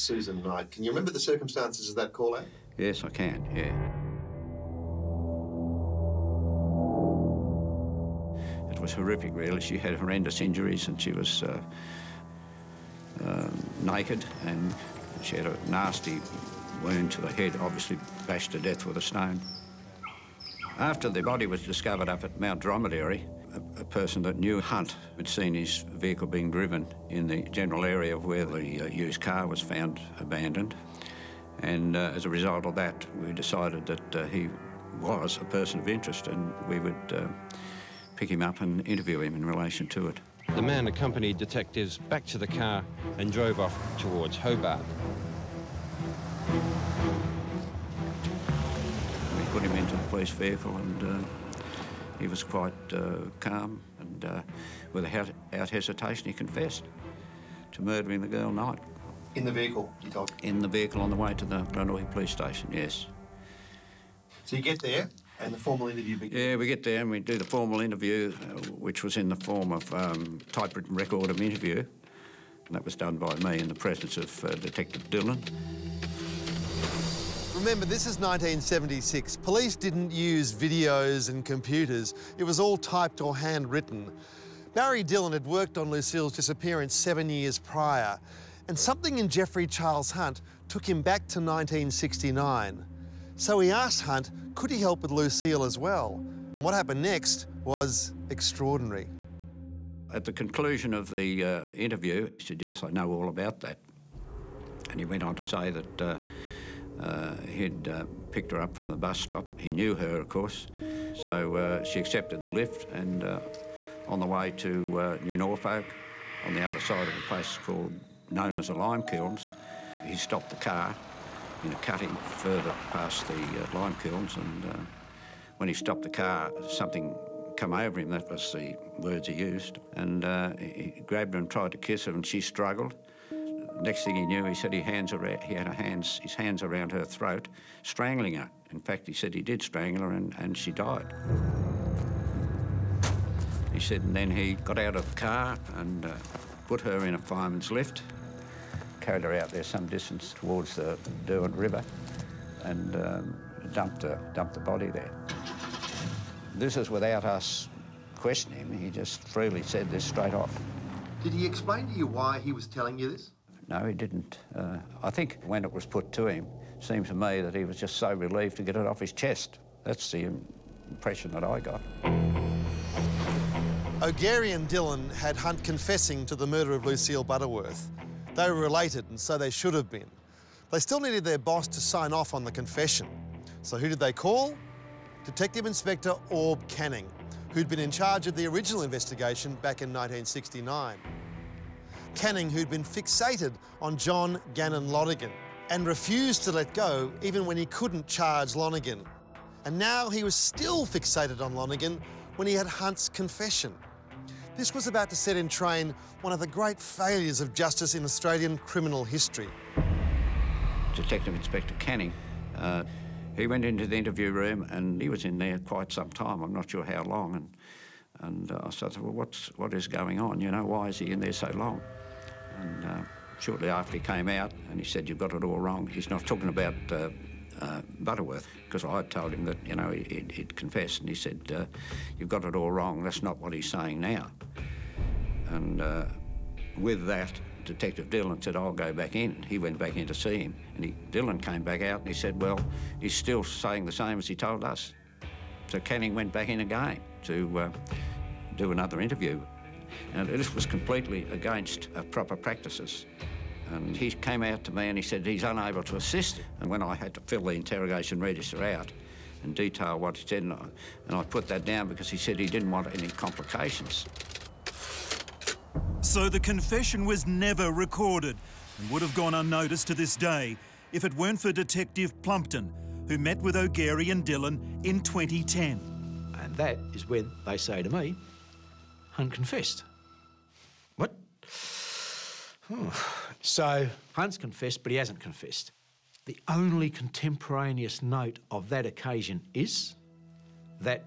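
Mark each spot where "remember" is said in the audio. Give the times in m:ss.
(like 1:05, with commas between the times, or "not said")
0:00, 1:17.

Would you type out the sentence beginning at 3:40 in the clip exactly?
You know, why is he in there so long?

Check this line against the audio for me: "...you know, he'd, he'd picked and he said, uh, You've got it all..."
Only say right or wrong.
wrong.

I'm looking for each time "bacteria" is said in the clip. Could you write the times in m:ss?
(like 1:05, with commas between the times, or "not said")
not said.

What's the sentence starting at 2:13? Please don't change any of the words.
Next thing he knew, he said he, hands around, he had hands, his hands around her throat, strangling her.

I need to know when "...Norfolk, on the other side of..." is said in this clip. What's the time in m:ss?
1:55.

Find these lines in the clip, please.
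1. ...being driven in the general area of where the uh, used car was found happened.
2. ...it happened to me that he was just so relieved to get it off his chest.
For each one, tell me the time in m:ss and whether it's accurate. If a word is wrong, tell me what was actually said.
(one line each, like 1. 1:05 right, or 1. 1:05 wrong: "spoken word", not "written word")
1. 0:26 wrong: "abandoned", not "happened"
2. 2:46 wrong: "seemed", not "happened".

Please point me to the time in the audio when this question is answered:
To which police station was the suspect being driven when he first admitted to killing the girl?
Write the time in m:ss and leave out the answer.
1:01.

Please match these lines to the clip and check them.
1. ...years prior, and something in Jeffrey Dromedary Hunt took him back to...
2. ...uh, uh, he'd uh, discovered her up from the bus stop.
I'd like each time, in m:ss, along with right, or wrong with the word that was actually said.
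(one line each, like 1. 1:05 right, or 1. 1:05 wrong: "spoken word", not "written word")
1. 1:27 wrong: "Charles", not "Dromedary"
2. 1:46 wrong: "picked", not "discovered".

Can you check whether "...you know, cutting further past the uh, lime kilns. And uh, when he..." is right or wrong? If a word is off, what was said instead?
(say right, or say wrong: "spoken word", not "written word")
right.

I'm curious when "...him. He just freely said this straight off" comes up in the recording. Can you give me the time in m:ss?
2:38.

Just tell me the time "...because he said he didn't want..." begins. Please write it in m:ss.
4:21.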